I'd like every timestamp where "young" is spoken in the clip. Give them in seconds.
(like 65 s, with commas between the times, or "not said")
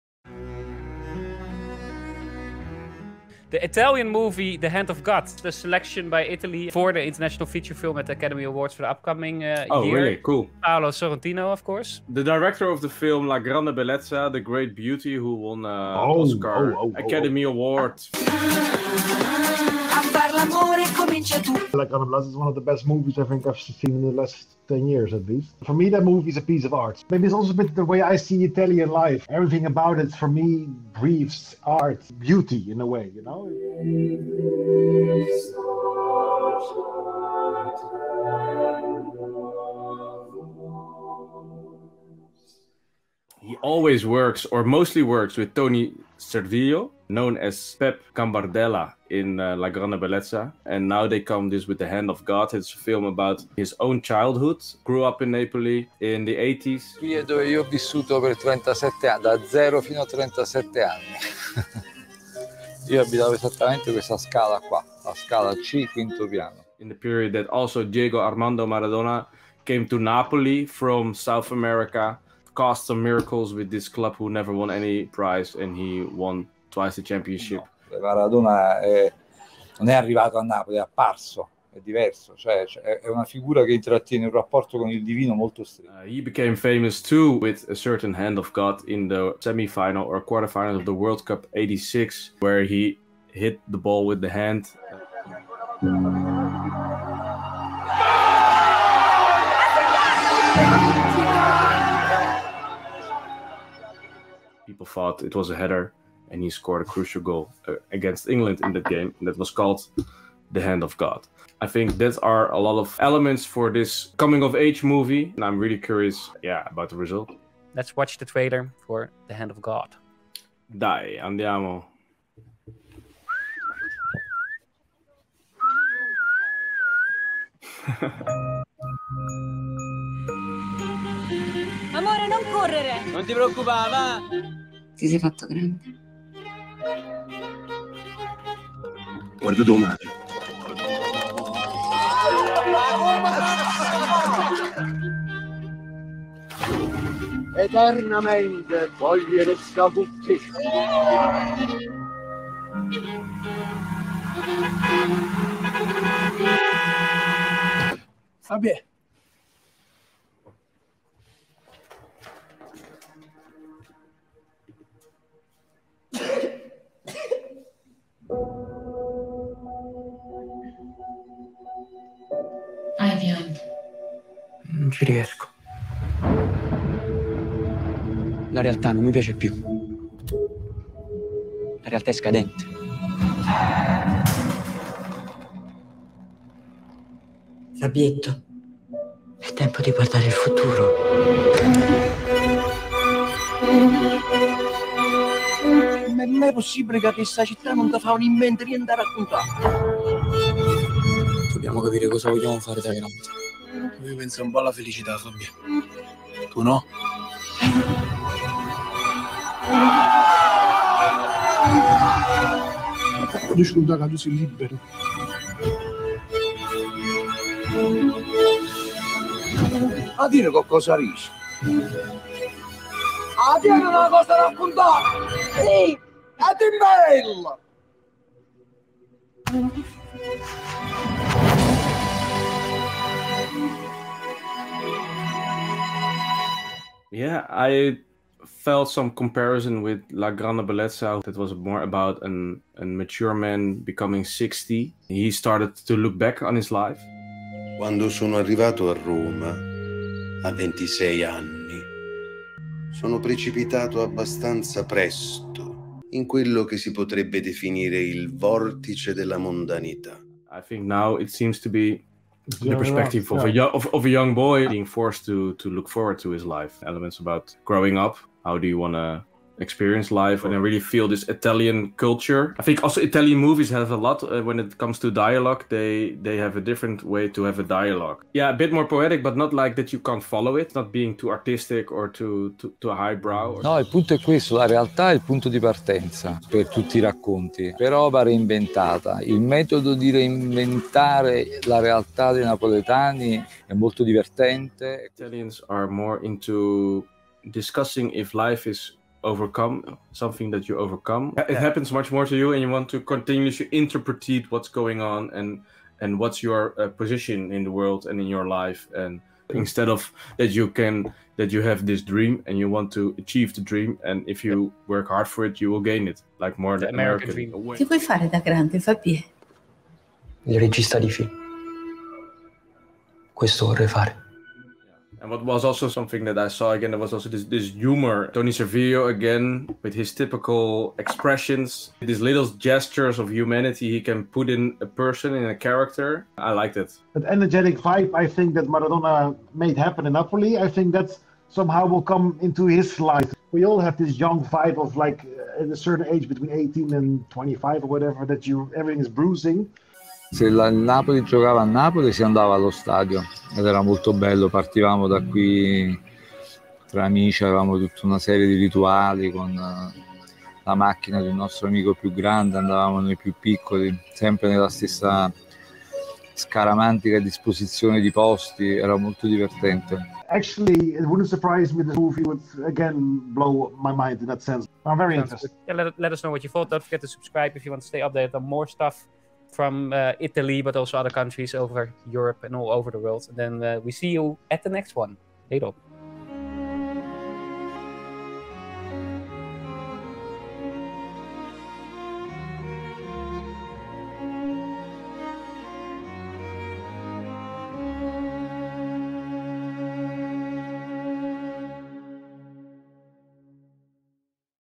264 s, 344 s.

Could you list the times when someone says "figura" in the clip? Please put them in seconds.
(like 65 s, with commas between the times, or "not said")
83 s.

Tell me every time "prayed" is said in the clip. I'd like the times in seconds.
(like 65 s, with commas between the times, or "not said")
not said.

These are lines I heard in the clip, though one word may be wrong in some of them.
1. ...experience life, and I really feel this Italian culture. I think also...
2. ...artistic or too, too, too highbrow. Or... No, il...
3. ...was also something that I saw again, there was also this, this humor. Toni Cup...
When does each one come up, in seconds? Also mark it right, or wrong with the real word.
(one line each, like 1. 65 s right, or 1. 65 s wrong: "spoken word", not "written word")
1. 269 s right
2. 281 s right
3. 325 s wrong: "Servillo", not "Cup".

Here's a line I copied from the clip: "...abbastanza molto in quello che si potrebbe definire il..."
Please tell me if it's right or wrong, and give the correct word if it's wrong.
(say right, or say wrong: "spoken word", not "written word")
wrong: "presto", not "molto".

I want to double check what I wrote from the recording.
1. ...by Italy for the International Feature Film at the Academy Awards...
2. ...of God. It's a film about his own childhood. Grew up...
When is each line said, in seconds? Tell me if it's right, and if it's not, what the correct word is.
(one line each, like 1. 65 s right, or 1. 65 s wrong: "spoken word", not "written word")
1. 6 s right
2. 52 s right.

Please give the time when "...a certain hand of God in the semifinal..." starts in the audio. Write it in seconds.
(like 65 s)
87 s.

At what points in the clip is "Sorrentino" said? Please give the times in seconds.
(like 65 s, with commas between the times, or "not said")
10 s.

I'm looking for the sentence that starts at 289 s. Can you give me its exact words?
Il metodo di reinventare la realtà dei napoletani è molto divertente.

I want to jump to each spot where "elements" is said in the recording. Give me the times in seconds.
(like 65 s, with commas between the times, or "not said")
112 s, 266 s.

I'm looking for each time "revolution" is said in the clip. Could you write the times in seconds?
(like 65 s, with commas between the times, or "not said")
not said.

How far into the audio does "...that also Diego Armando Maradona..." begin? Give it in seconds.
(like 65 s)
67 s.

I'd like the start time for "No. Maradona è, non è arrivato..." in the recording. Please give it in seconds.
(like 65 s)
77 s.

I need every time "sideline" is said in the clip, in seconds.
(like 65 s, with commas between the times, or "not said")
not said.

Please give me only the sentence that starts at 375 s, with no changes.
Yeah, let, let us know what you thought.